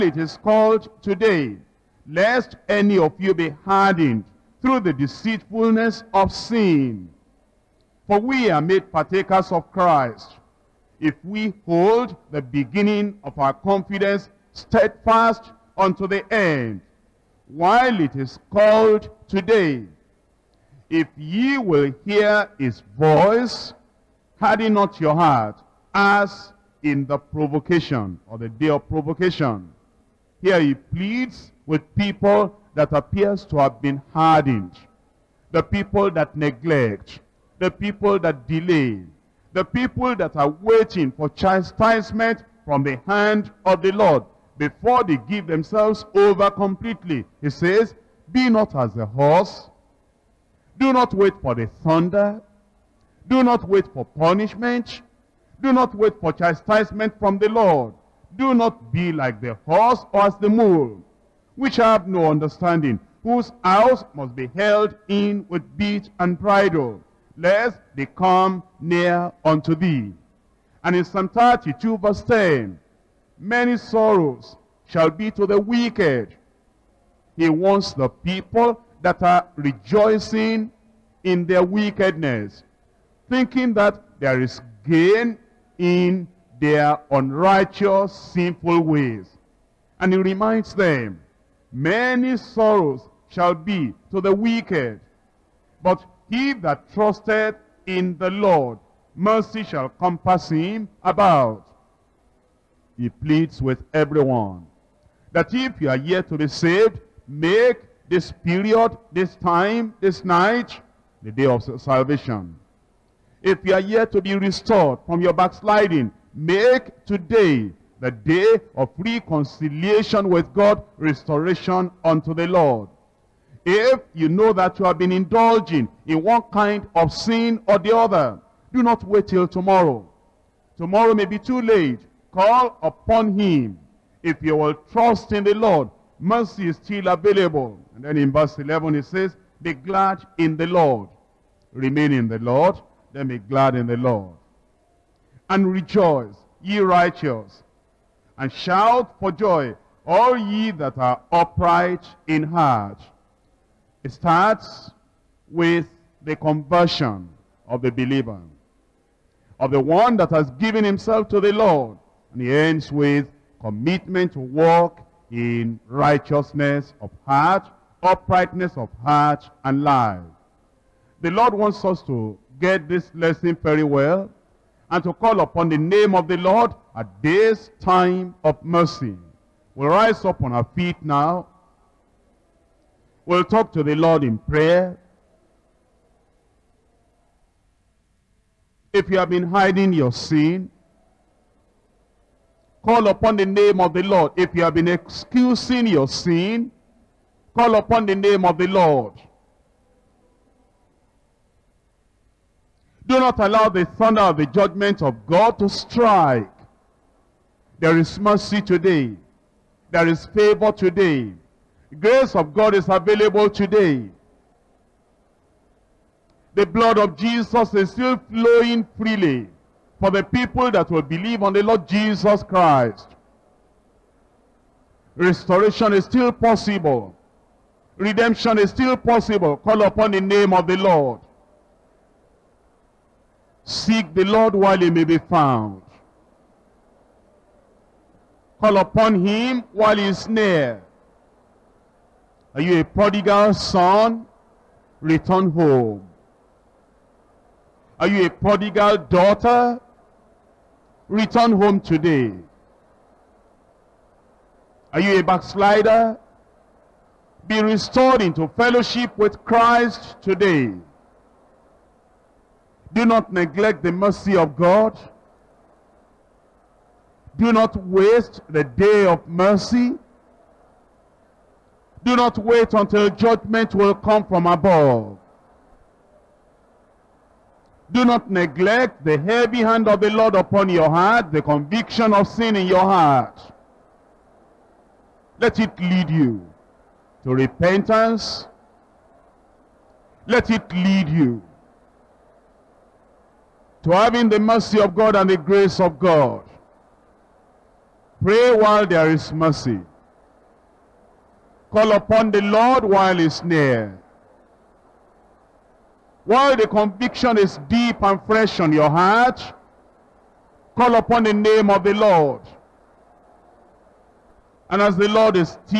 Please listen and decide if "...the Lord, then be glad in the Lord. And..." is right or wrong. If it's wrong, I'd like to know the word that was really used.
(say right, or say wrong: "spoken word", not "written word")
right.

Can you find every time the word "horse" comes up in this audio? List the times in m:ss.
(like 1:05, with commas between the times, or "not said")
0:49, 0:59.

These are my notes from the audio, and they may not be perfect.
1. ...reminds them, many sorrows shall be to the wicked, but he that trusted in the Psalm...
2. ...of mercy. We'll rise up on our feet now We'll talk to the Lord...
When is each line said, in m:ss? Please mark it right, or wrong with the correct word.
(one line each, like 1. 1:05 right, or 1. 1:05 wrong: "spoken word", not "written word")
1. 1:30 wrong: "Lord", not "Psalm"
2. 2:58 right.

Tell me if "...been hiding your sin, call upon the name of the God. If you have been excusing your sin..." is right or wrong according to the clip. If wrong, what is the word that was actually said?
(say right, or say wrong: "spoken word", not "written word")
wrong: "Lord", not "God".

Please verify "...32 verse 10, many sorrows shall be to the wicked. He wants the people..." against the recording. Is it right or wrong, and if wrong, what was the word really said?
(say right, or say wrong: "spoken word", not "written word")
right.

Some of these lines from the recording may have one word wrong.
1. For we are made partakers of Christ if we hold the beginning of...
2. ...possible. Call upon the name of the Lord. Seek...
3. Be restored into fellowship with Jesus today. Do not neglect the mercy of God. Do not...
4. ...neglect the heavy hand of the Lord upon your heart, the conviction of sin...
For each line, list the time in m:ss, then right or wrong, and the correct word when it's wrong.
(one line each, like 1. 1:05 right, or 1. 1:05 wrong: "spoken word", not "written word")
1. 0:08 right
2. 3:48 right
3. 4:17 wrong: "Christ", not "Jesus"
4. 4:38 right.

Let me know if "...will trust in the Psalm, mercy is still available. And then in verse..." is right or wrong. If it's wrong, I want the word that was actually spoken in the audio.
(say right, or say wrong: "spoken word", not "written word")
wrong: "Lord", not "Psalm".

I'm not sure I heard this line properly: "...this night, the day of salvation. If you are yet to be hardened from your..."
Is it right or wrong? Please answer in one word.
wrong.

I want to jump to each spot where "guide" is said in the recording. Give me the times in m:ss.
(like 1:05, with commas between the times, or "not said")
not said.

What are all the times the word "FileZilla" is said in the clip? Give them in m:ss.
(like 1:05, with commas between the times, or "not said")
not said.